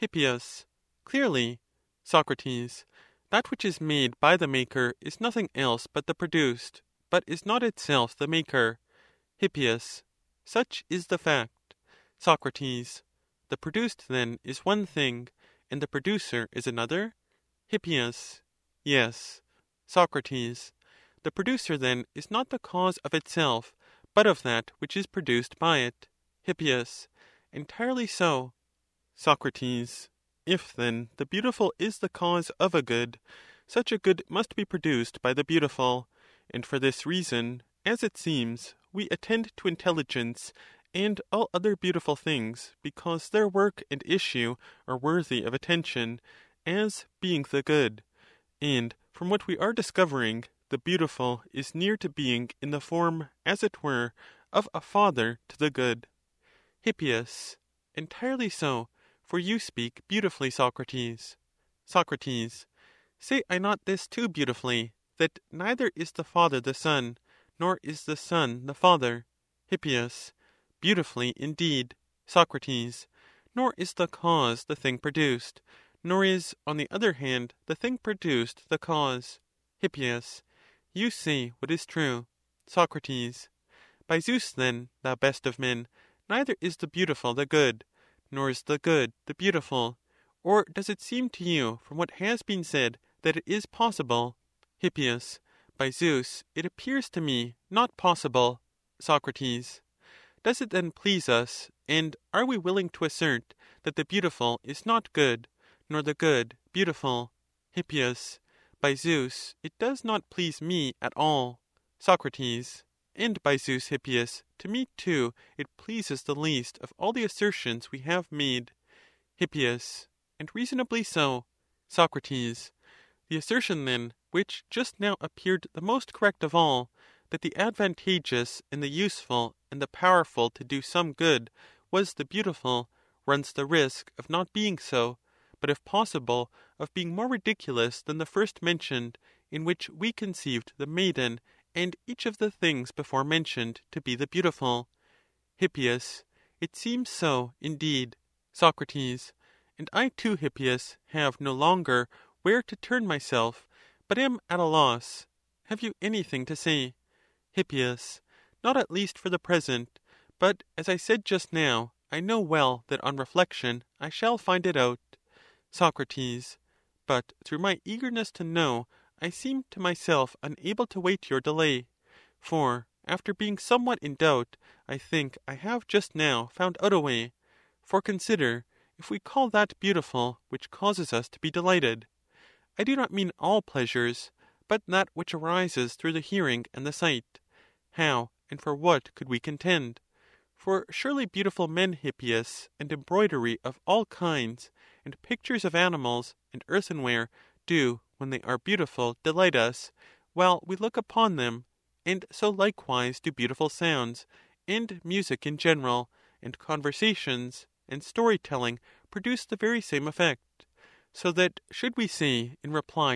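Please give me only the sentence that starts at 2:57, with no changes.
For consider, if we call that beautiful which causes us to be delighted.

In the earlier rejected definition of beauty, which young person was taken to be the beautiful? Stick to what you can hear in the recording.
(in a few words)
the maiden.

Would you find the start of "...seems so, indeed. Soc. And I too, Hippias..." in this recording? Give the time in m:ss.
2:26.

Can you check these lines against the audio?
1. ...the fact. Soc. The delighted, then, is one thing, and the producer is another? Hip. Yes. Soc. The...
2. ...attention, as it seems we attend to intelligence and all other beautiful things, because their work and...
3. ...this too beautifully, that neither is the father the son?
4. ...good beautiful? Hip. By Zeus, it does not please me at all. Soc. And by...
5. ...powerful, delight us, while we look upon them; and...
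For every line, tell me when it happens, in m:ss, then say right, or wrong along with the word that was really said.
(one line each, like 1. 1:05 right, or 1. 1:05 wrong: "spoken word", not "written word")
1. 0:11 wrong: "produced", not "delighted"
2. 0:37 wrong: "reason", not "attention"
3. 1:03 right
4. 1:46 right
5. 3:18 wrong: "beautiful", not "powerful".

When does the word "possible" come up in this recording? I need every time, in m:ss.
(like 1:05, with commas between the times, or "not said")
1:33, 1:37, 2:15.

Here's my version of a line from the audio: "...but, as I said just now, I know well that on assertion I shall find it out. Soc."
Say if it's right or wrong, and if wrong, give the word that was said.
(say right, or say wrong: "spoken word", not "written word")
wrong: "reflection", not "assertion".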